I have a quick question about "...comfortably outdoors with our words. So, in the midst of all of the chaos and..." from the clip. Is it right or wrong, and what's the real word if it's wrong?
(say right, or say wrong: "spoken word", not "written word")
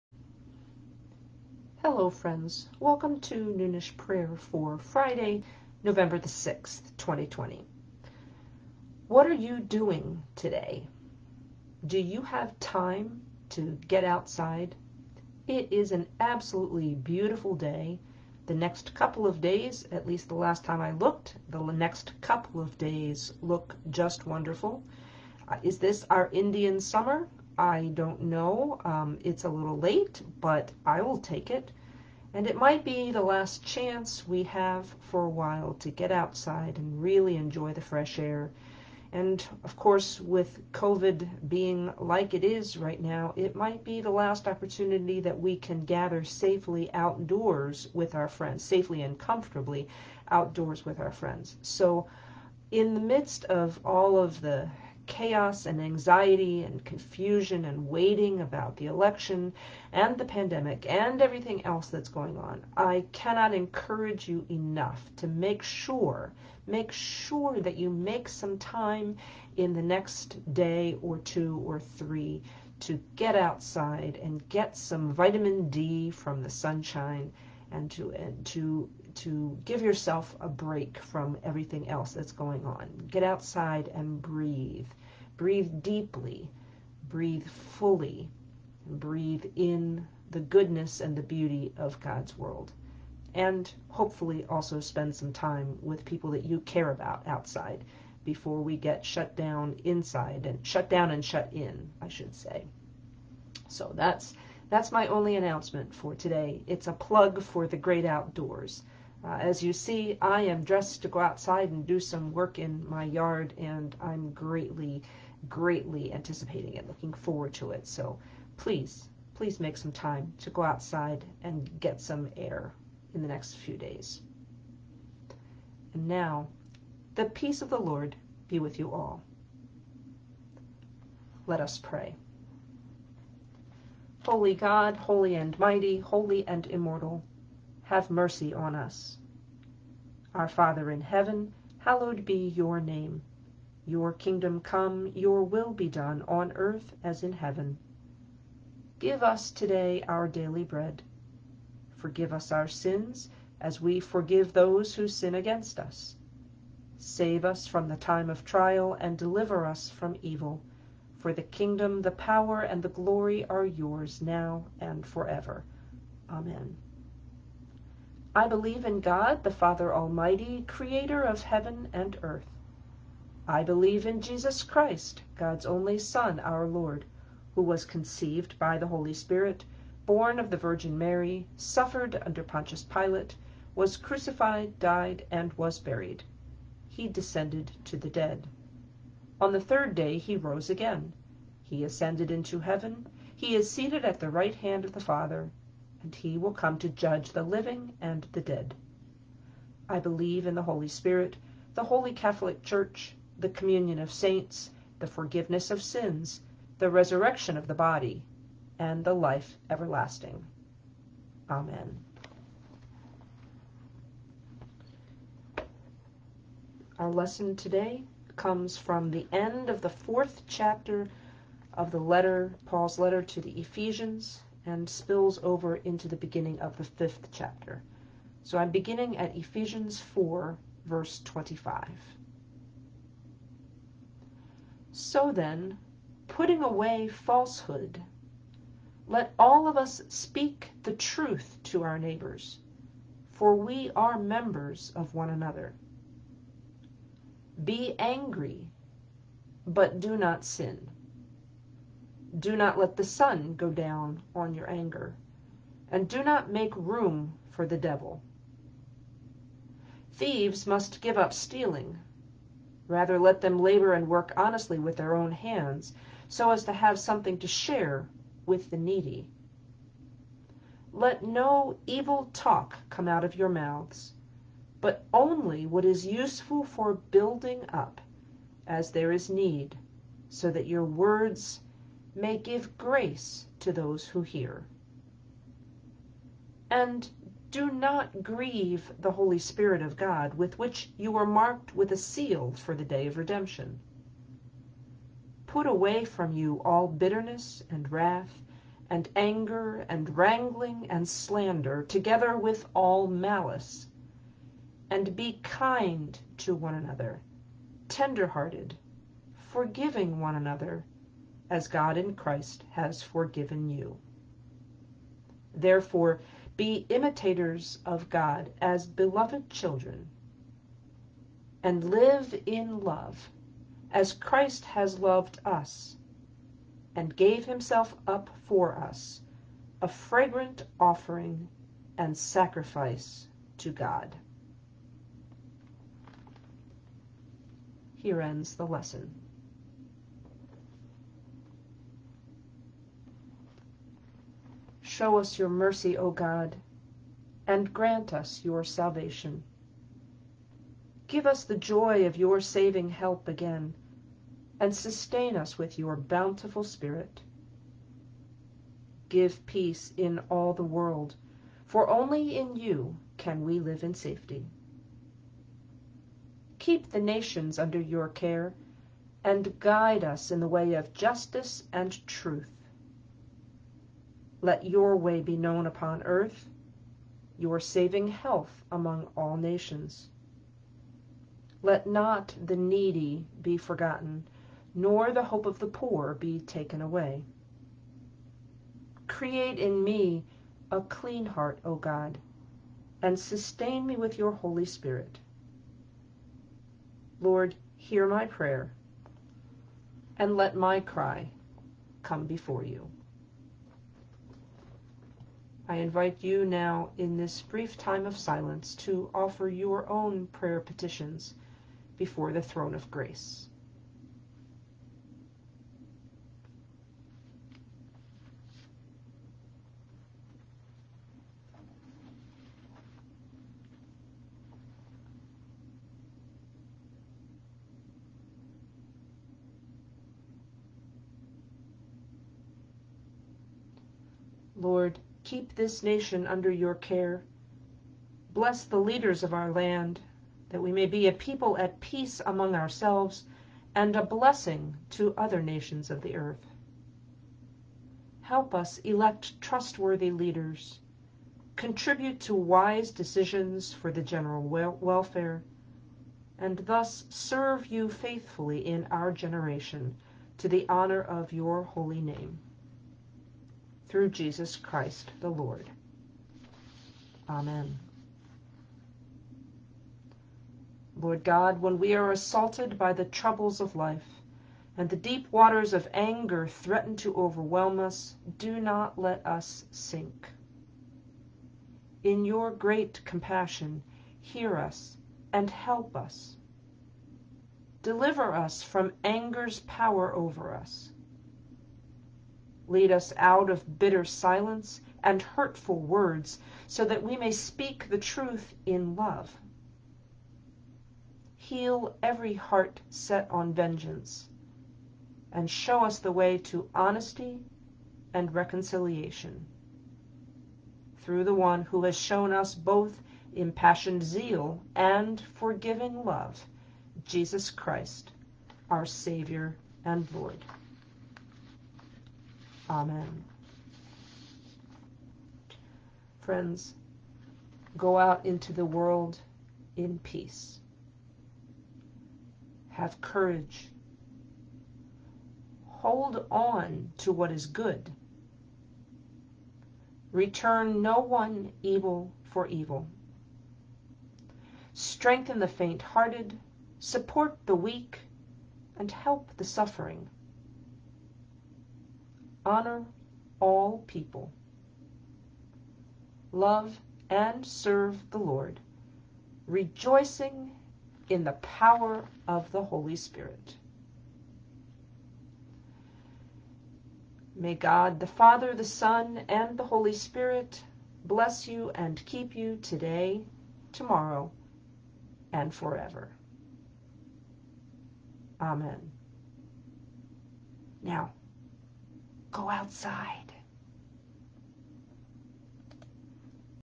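wrong: "friends", not "words".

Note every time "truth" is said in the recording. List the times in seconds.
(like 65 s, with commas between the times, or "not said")
240 s, 372 s, 497 s.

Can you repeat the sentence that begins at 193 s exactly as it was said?
He is seated at the right hand of the Father and he will come to judge the living and the dead.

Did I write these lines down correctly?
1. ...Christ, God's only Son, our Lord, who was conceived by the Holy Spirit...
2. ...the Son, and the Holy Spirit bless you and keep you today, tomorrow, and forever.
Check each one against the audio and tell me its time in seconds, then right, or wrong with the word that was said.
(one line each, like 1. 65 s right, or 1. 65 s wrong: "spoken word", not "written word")
1. 174 s right
2. 568 s right.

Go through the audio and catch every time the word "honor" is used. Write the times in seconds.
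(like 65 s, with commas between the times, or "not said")
460 s, 552 s.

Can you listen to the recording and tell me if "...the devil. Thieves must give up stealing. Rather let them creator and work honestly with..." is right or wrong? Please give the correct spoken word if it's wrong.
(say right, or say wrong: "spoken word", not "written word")
wrong: "labor", not "creator".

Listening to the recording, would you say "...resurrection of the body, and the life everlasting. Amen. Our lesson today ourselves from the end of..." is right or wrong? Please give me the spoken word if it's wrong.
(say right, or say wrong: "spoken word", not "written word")
wrong: "comes", not "ourselves".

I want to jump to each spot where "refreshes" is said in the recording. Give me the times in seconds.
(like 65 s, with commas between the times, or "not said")
not said.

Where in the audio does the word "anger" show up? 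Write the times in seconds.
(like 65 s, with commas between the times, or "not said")
254 s, 299 s, 475 s, 489 s.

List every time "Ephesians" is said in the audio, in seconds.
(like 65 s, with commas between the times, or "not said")
223 s, 229 s.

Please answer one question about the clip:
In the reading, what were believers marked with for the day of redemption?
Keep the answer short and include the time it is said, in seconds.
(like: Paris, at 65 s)
a seal, at 291 s.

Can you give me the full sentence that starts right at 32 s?
And it might be the last chance we have for a while to get outside and really enjoy the fresh air.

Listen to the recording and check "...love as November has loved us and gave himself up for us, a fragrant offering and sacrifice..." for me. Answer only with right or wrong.
wrong.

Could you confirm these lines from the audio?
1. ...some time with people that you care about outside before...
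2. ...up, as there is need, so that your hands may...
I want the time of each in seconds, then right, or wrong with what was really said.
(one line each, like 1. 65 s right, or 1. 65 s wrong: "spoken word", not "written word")
1. 95 s right
2. 277 s wrong: "words", not "hands".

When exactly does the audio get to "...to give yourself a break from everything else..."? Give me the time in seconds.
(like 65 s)
79 s.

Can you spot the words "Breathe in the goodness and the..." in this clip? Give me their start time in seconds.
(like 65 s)
88 s.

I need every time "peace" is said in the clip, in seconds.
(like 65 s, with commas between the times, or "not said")
127 s, 359 s, 441 s, 529 s.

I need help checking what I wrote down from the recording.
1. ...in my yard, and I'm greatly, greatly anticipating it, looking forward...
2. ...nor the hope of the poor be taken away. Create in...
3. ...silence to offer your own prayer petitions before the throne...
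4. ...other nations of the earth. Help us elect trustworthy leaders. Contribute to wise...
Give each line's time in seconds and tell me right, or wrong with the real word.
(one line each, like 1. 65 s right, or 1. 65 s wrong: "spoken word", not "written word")
1. 112 s right
2. 384 s right
3. 408 s right
4. 445 s right.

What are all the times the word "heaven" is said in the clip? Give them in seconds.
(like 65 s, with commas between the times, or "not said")
141 s, 147 s, 171 s, 192 s.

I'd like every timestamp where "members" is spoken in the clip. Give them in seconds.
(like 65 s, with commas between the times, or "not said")
244 s.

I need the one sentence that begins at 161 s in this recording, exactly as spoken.
For the kingdom, the power, and the glory are yours now and forever.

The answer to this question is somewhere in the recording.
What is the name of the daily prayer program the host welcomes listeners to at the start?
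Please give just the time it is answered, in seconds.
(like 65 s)
3 s.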